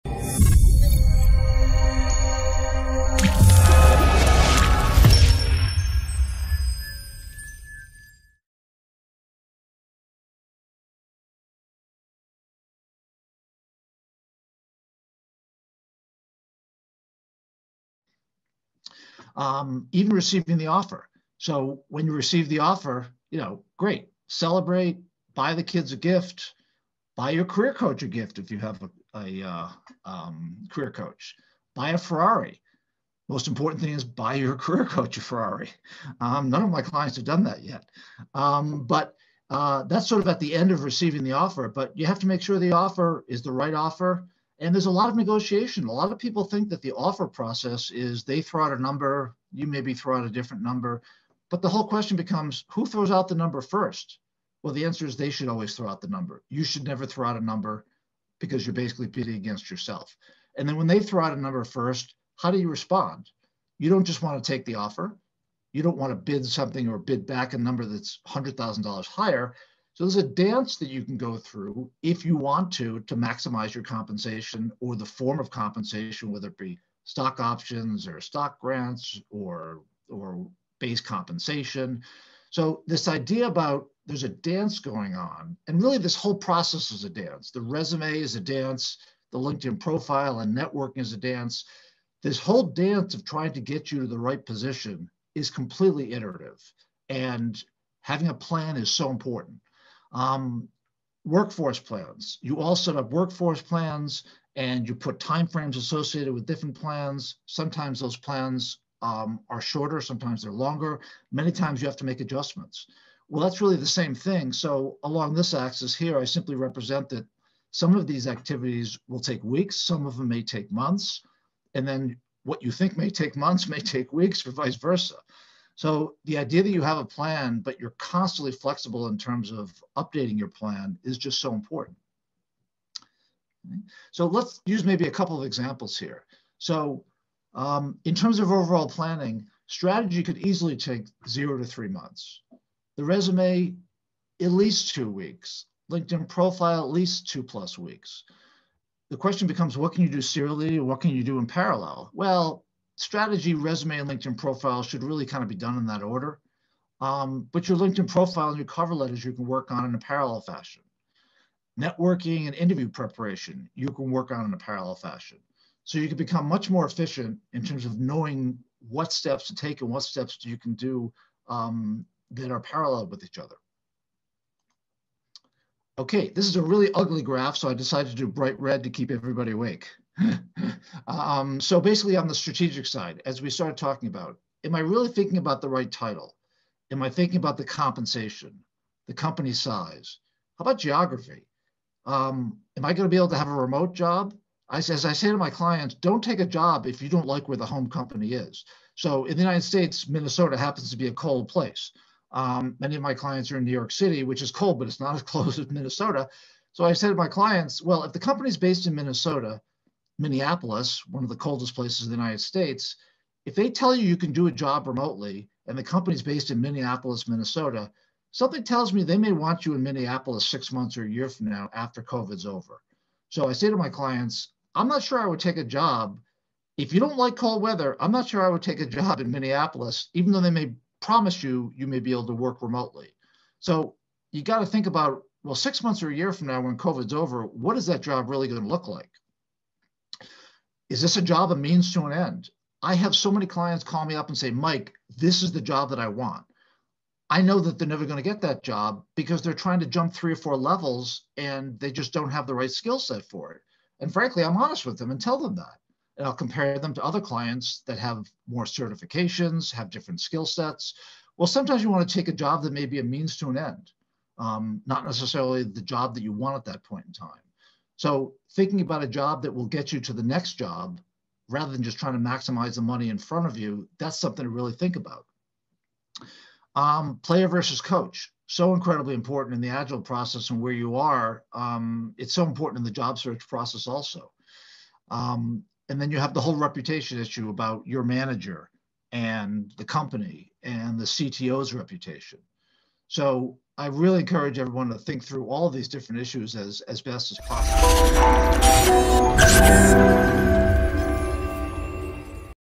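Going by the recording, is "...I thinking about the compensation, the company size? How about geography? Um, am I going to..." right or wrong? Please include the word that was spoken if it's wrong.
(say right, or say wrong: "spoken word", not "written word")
right.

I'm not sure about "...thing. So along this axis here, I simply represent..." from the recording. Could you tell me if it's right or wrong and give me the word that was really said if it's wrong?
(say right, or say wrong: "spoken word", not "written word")
right.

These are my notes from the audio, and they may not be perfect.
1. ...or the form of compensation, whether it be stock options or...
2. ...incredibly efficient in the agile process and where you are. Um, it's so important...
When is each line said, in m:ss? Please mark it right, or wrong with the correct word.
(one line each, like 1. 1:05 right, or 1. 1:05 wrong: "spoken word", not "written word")
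1. 1:14 right
2. 4:38 wrong: "important", not "efficient".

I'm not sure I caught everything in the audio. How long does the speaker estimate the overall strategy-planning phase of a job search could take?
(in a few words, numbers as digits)
0 to 3 months.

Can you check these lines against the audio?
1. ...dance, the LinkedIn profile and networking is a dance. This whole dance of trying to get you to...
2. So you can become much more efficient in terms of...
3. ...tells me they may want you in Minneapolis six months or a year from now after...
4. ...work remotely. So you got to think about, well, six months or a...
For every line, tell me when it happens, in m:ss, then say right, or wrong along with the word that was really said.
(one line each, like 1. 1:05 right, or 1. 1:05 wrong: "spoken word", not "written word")
1. 1:28 right
2. 2:45 right
3. 3:38 right
4. 3:52 right.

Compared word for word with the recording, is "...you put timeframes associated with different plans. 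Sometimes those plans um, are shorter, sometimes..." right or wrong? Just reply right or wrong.
right.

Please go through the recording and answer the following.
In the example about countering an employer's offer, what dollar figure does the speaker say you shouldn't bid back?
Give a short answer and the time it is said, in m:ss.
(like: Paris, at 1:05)
$100,000, at 1:08.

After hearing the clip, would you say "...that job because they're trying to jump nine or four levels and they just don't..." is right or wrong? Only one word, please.
wrong.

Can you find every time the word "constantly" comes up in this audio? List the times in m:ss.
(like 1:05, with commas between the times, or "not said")
2:07.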